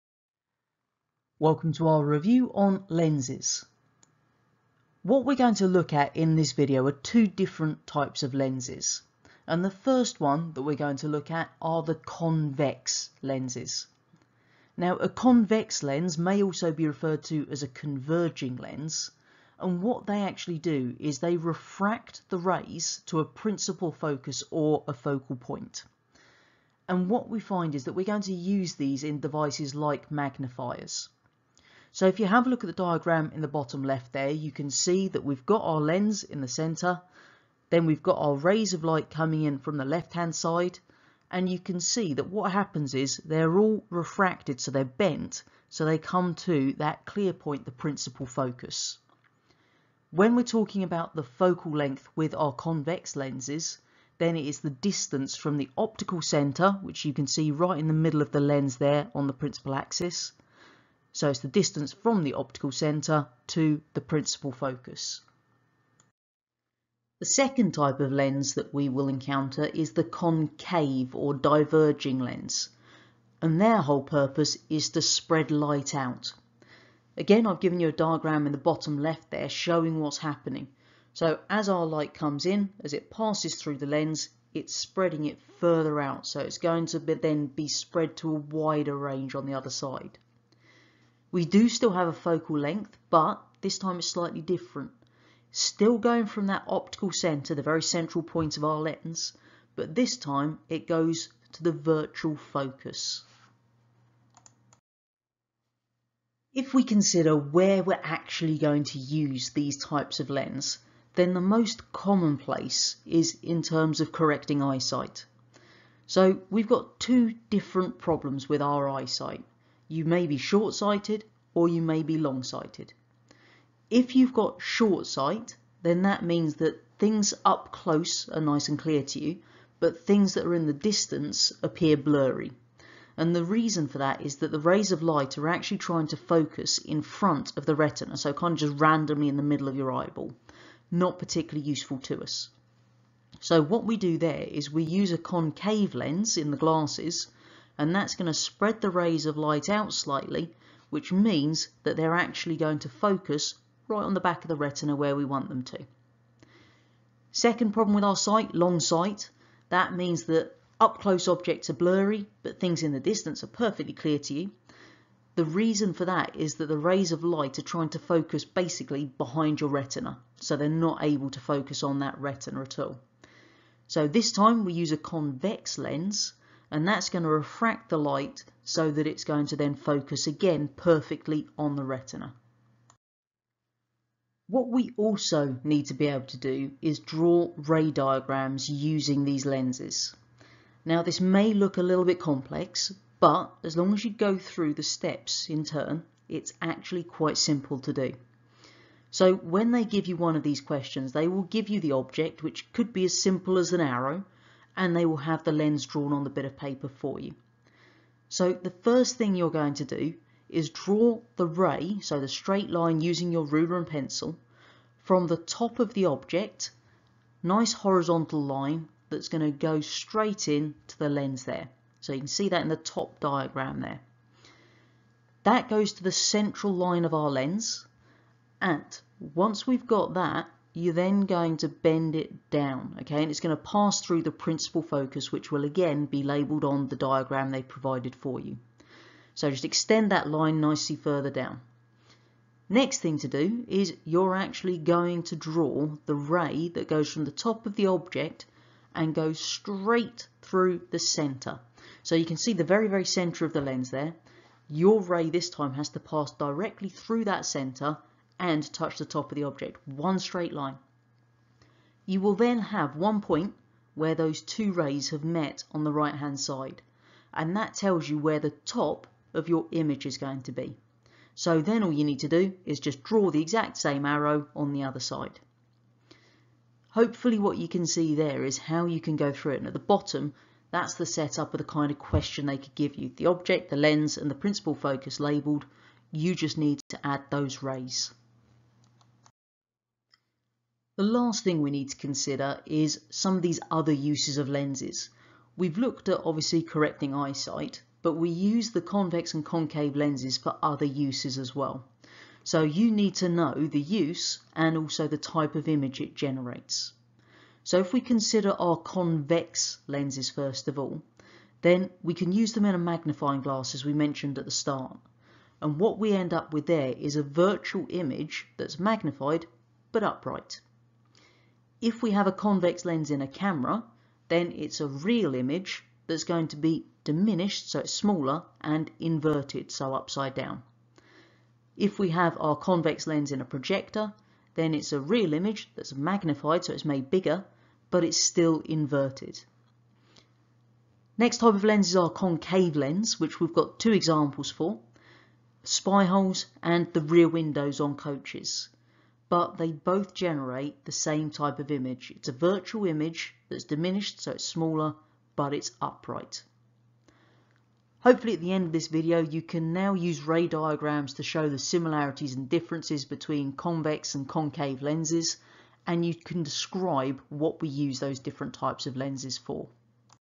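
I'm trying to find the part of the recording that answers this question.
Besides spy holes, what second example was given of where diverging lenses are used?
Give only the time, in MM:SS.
05:47.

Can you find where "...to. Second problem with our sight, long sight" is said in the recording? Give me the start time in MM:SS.
02:35.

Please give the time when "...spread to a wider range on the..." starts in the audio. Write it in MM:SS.
01:27.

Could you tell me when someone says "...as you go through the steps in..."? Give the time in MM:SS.
03:13.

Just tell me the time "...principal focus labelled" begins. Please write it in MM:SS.
04:44.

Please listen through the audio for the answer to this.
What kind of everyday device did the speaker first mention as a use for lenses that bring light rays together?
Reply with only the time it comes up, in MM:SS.
00:30.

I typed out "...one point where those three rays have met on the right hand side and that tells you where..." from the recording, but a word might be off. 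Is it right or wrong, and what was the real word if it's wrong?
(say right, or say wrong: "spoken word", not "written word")
wrong: "two", not "three".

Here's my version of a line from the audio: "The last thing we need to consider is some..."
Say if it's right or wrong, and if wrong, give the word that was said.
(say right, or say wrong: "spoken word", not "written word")
right.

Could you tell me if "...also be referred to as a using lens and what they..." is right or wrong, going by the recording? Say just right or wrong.
wrong.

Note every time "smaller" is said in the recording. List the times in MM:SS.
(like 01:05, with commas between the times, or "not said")
05:27, 05:54.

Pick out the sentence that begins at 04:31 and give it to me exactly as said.
So then all you need to do is just draw the exact same arrow on the other side.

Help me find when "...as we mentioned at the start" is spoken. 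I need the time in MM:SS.
05:13.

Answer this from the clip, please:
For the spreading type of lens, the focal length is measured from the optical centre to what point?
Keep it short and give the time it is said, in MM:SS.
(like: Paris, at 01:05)
virtual focus, at 01:41.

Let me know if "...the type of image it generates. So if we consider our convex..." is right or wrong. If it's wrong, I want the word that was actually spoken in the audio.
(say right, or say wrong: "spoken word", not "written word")
right.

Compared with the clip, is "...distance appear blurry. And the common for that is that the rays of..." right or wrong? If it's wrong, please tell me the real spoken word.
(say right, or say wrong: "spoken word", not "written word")
wrong: "reason", not "common".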